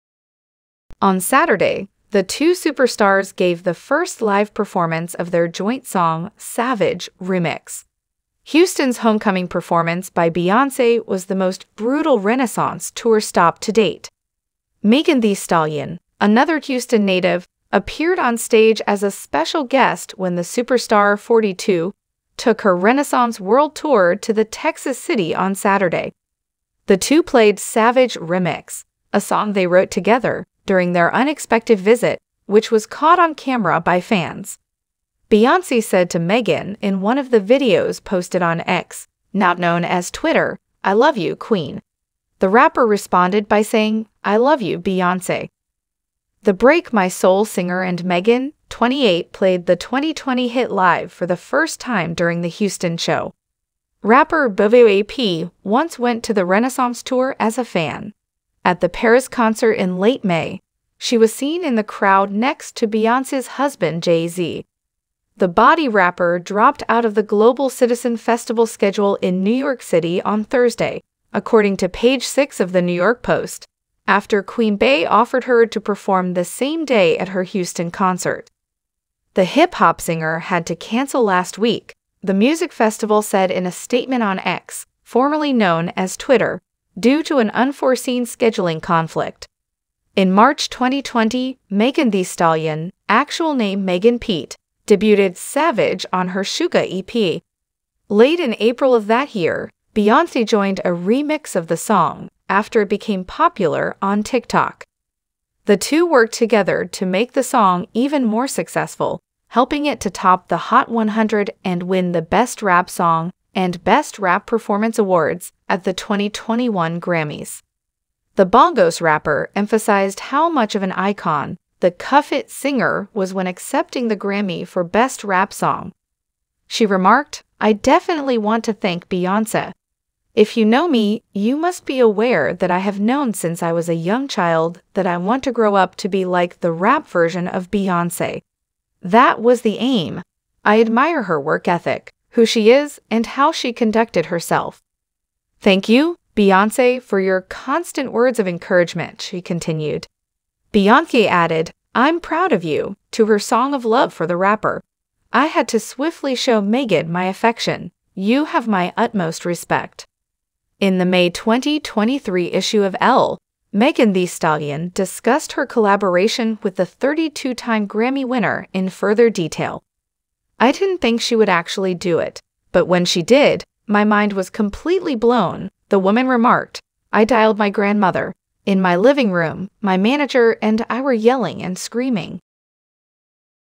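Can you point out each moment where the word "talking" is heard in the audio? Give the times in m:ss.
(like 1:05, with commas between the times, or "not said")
not said.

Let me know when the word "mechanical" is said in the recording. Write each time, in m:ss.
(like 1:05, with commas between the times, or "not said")
not said.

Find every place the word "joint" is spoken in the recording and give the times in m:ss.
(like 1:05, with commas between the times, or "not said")
0:05.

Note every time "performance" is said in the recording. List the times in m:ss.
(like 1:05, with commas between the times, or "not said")
0:04, 0:09.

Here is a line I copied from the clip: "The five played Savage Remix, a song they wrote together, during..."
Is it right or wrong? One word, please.
wrong.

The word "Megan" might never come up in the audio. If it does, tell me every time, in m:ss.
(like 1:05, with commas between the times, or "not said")
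0:14, 0:36.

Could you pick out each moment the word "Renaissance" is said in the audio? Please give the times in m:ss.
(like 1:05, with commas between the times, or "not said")
0:12, 0:22.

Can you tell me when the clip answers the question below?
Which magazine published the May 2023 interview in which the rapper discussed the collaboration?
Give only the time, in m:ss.
2:43.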